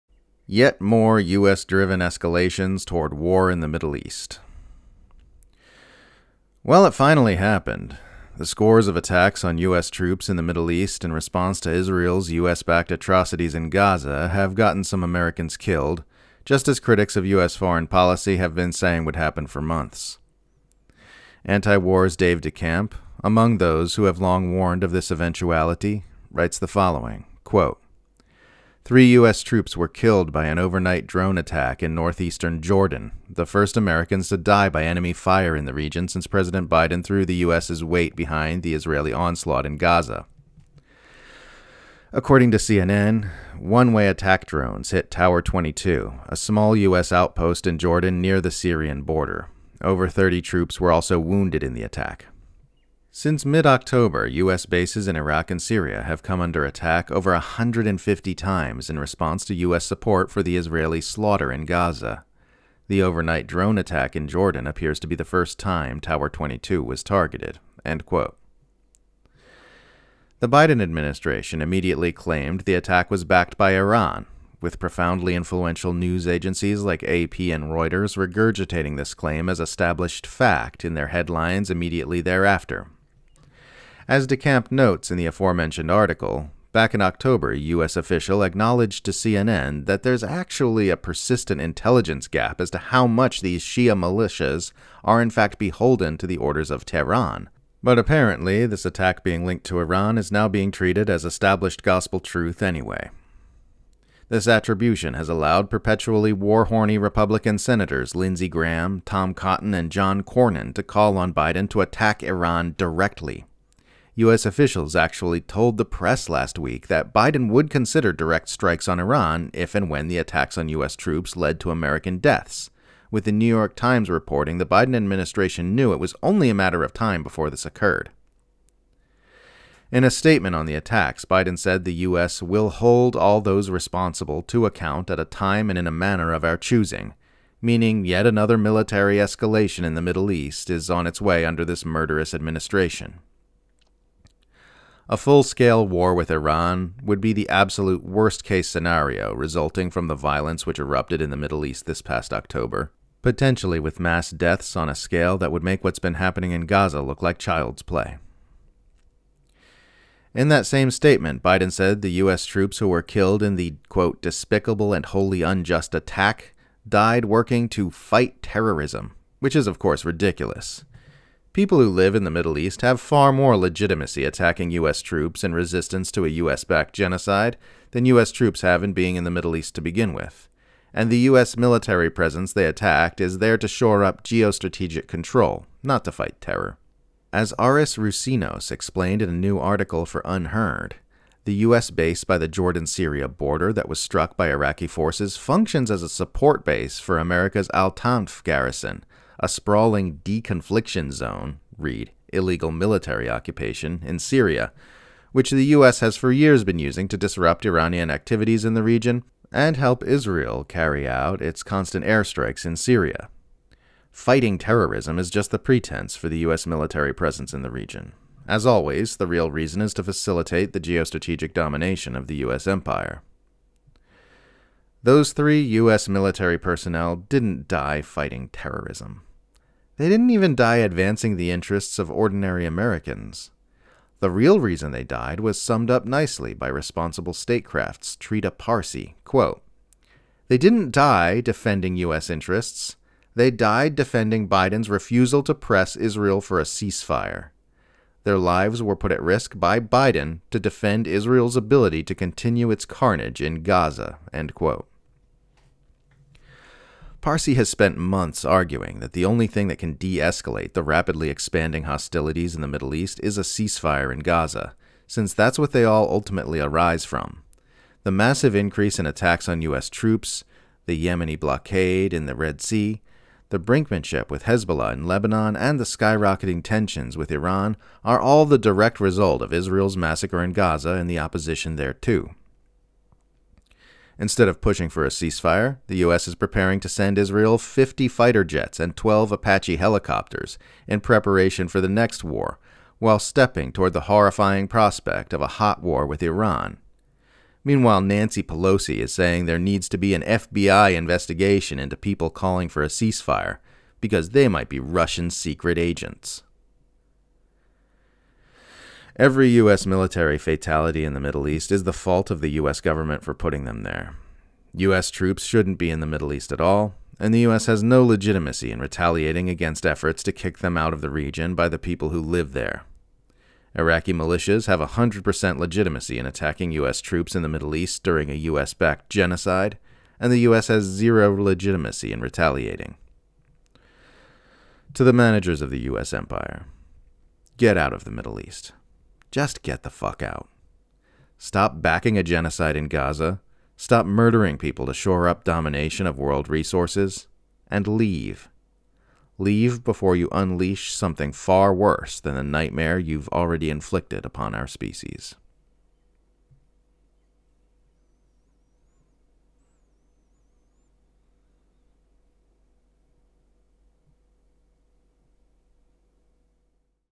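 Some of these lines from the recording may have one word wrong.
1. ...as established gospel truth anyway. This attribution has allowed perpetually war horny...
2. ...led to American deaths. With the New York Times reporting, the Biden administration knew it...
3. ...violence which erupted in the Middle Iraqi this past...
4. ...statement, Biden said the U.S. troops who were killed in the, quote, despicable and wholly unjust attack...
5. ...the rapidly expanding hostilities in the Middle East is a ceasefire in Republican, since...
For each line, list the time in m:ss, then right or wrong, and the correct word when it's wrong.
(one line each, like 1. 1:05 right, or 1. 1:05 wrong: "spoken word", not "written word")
1. 1:41 right
2. 2:01 right
3. 2:30 wrong: "East", not "Iraqi"
4. 2:40 right
5. 4:20 wrong: "Gaza", not "Republican".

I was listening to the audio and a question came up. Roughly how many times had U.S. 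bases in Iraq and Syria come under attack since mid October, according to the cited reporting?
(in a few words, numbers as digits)
over 150.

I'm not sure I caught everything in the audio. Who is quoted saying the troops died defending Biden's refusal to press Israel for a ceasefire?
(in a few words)
Trita Parsi.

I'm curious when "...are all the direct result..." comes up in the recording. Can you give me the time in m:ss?
4:38.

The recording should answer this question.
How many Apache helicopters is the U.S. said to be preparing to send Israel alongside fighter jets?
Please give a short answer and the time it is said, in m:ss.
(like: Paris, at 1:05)
12, at 4:48.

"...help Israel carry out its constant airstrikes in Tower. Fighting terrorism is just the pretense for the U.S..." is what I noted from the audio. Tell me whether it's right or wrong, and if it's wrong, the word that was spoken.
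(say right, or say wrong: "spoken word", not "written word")
wrong: "Syria", not "Tower".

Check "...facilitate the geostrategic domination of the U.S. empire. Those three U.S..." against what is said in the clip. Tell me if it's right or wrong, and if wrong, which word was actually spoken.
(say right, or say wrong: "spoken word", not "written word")
right.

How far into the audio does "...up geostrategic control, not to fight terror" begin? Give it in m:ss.
3:04.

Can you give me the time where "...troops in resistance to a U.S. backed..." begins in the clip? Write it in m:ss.
2:55.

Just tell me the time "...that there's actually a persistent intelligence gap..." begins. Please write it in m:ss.
1:29.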